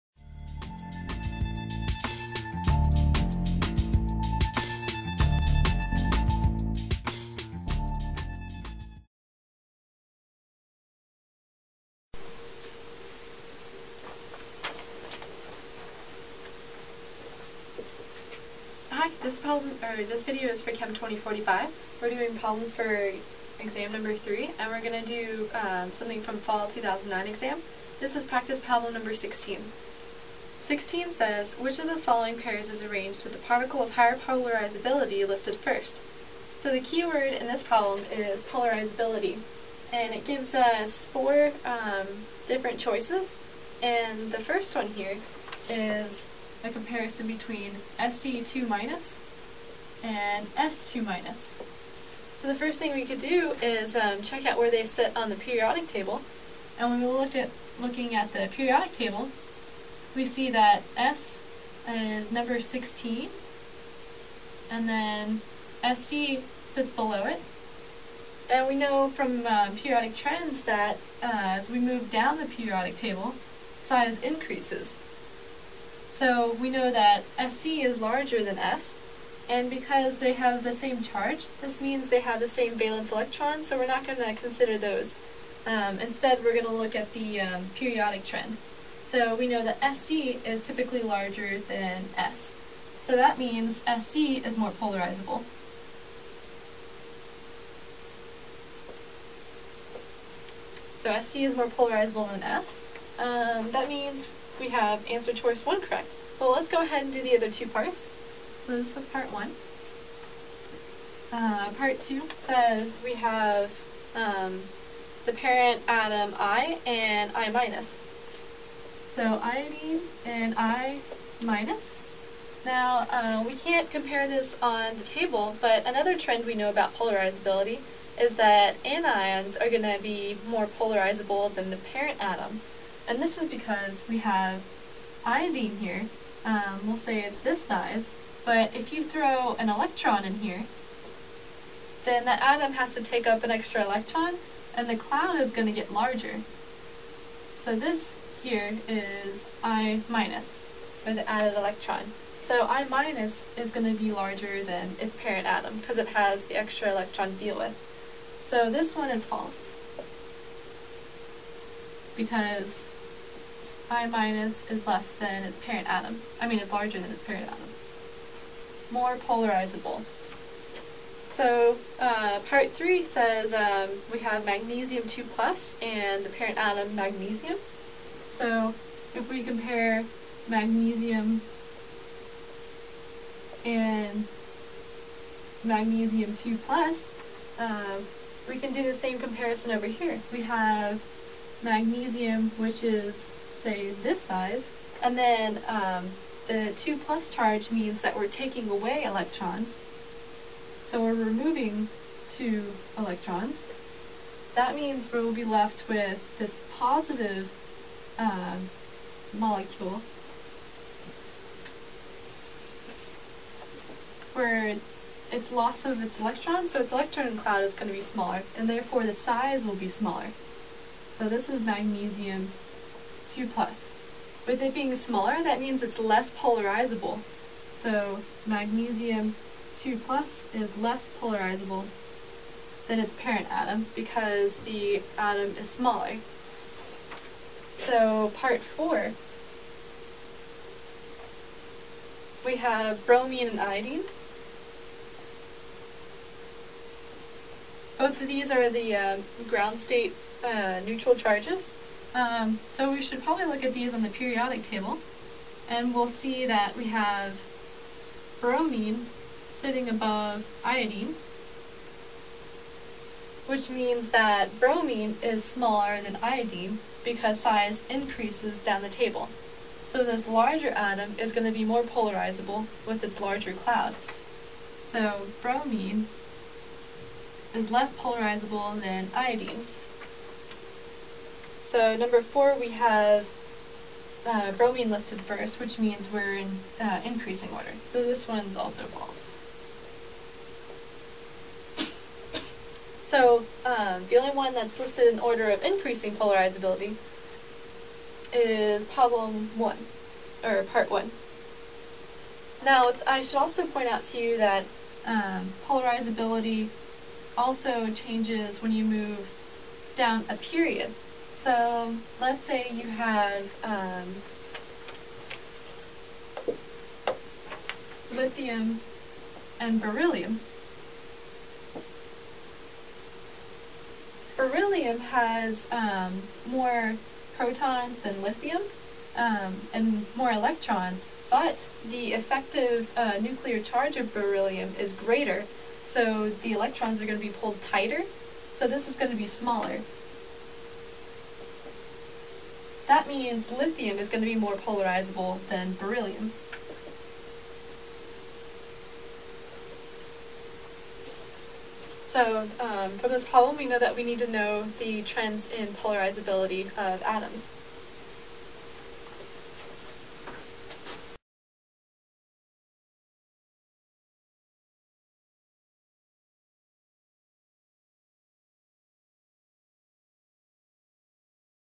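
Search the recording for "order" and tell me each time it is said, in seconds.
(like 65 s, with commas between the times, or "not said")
287 s, 295 s.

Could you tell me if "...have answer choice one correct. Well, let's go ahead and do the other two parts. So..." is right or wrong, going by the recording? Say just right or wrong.
right.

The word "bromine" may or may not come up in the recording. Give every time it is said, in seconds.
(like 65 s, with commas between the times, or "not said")
243 s, 258 s, 264 s, 275 s, 284 s.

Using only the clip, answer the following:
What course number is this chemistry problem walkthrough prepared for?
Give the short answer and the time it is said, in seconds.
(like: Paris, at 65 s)
Chem 2045, at 20 s.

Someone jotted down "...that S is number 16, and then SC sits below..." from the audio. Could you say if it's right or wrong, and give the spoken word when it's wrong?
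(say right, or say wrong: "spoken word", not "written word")
right.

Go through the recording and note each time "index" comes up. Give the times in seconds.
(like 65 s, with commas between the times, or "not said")
not said.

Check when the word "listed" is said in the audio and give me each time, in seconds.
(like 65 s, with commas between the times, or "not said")
35 s, 284 s, 294 s.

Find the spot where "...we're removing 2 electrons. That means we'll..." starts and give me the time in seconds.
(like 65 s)
201 s.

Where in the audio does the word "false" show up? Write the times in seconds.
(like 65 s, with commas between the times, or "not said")
159 s, 288 s.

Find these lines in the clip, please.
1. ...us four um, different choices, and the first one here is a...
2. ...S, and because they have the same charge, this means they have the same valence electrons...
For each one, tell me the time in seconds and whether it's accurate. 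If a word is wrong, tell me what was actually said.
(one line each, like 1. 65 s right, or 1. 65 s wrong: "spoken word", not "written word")
1. 40 s right
2. 78 s right.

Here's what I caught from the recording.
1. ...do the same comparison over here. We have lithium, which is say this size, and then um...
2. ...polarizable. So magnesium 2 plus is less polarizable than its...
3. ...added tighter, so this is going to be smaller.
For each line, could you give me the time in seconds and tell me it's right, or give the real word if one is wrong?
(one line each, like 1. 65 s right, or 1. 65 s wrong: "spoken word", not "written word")
1. 188 s wrong: "magnesium", not "lithium"
2. 226 s right
3. 337 s wrong: "pulled", not "added".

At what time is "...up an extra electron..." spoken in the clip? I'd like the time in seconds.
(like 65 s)
143 s.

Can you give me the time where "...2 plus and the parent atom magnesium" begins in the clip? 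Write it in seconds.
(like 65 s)
175 s.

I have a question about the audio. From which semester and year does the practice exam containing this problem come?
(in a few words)
Fall 2009.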